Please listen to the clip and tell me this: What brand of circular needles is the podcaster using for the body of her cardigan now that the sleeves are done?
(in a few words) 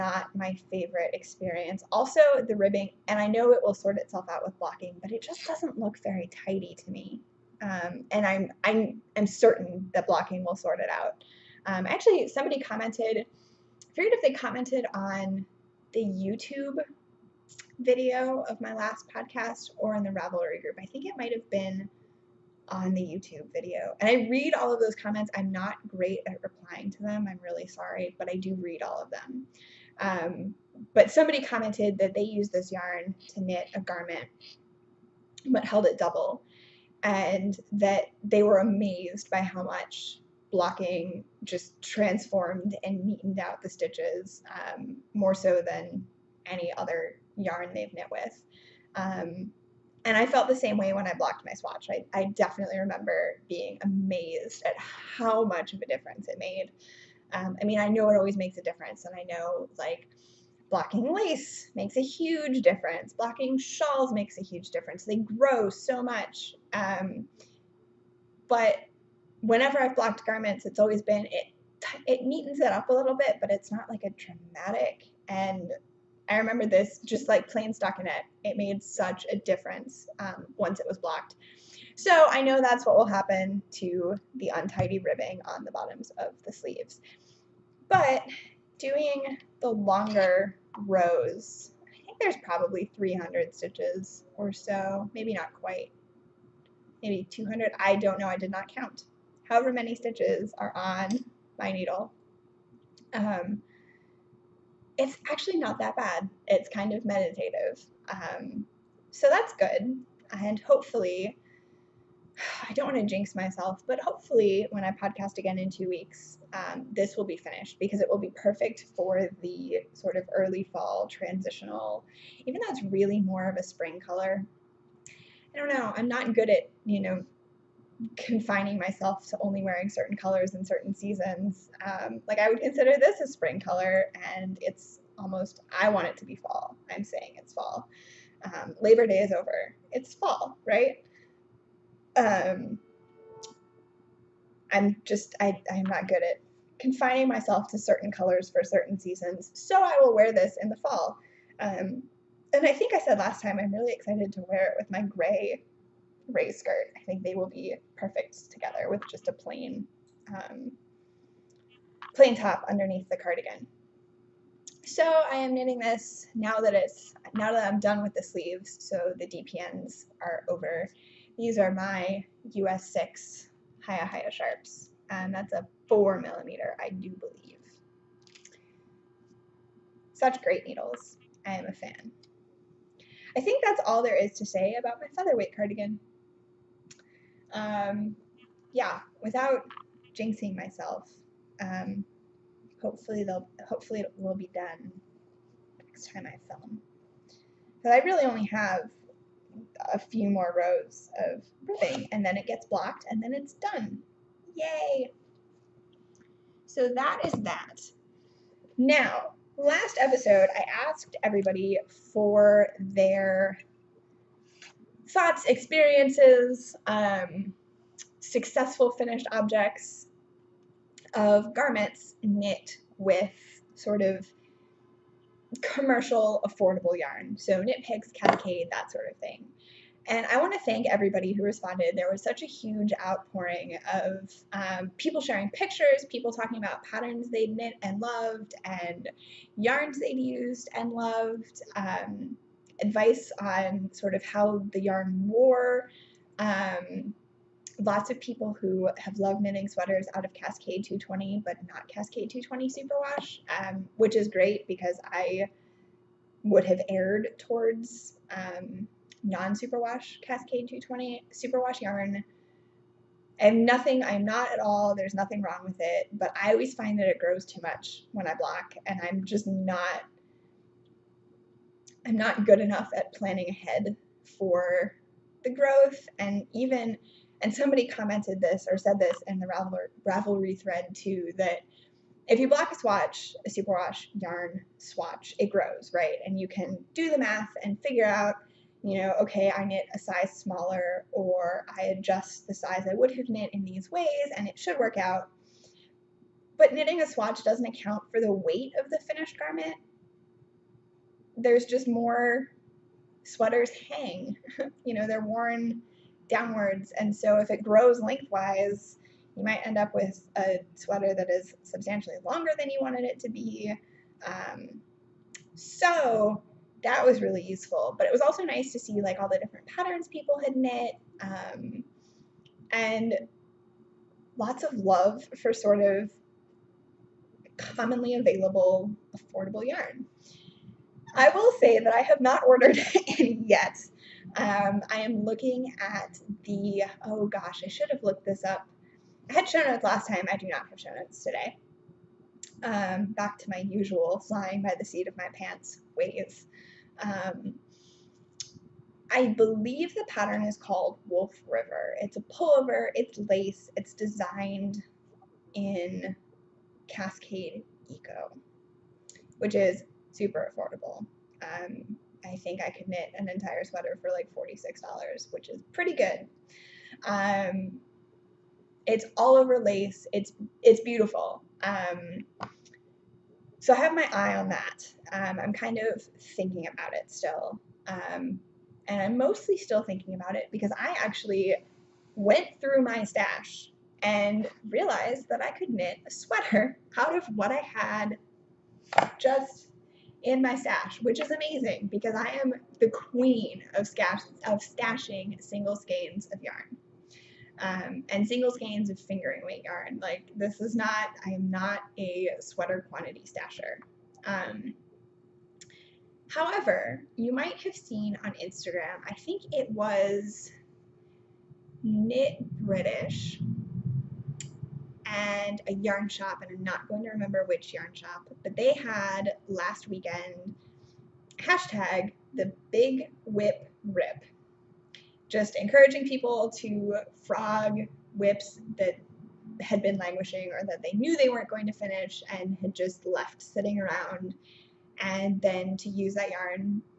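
HiyaHiya Sharps.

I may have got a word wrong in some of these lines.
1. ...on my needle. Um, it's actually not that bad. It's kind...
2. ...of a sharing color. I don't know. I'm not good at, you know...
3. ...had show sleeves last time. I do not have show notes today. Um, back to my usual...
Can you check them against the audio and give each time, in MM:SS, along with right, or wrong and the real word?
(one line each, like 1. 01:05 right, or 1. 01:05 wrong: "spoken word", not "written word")
1. 01:40 right
2. 02:03 wrong: "spring", not "sharing"
3. 05:39 wrong: "notes", not "sleeves".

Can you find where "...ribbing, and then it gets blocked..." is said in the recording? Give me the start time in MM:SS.
03:21.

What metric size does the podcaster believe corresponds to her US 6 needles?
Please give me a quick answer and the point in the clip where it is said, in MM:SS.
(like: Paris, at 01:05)
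4 millimeter, at 02:55.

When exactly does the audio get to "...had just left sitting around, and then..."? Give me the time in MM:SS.
07:12.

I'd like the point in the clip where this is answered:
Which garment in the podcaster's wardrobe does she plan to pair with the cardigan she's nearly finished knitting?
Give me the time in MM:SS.
02:35.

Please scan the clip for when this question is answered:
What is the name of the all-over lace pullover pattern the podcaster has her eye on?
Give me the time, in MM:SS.
05:51.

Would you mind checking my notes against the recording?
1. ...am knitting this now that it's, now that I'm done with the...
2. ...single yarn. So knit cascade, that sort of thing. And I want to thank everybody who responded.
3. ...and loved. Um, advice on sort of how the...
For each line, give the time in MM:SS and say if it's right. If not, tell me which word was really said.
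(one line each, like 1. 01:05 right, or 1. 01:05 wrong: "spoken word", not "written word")
1. 02:45 right
2. 03:46 wrong: "affordable", not "single"
3. 04:00 right.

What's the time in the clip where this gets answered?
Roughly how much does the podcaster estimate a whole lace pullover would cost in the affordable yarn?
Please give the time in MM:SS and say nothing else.
06:04.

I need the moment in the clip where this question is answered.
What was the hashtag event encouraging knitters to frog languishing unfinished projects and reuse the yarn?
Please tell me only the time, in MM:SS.
07:02.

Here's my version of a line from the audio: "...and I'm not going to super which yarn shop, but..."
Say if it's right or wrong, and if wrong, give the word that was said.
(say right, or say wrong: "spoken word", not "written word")
wrong: "remember", not "super".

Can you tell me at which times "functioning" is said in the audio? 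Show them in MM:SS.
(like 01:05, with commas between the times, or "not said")
not said.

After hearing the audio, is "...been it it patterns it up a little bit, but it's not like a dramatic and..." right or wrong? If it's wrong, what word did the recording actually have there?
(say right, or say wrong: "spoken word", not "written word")
wrong: "neatens", not "patterns".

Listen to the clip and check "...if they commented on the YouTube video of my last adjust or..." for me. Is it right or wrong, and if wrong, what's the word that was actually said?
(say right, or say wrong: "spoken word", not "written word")
wrong: "podcast", not "adjust".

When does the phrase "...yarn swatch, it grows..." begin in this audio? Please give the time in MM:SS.
04:44.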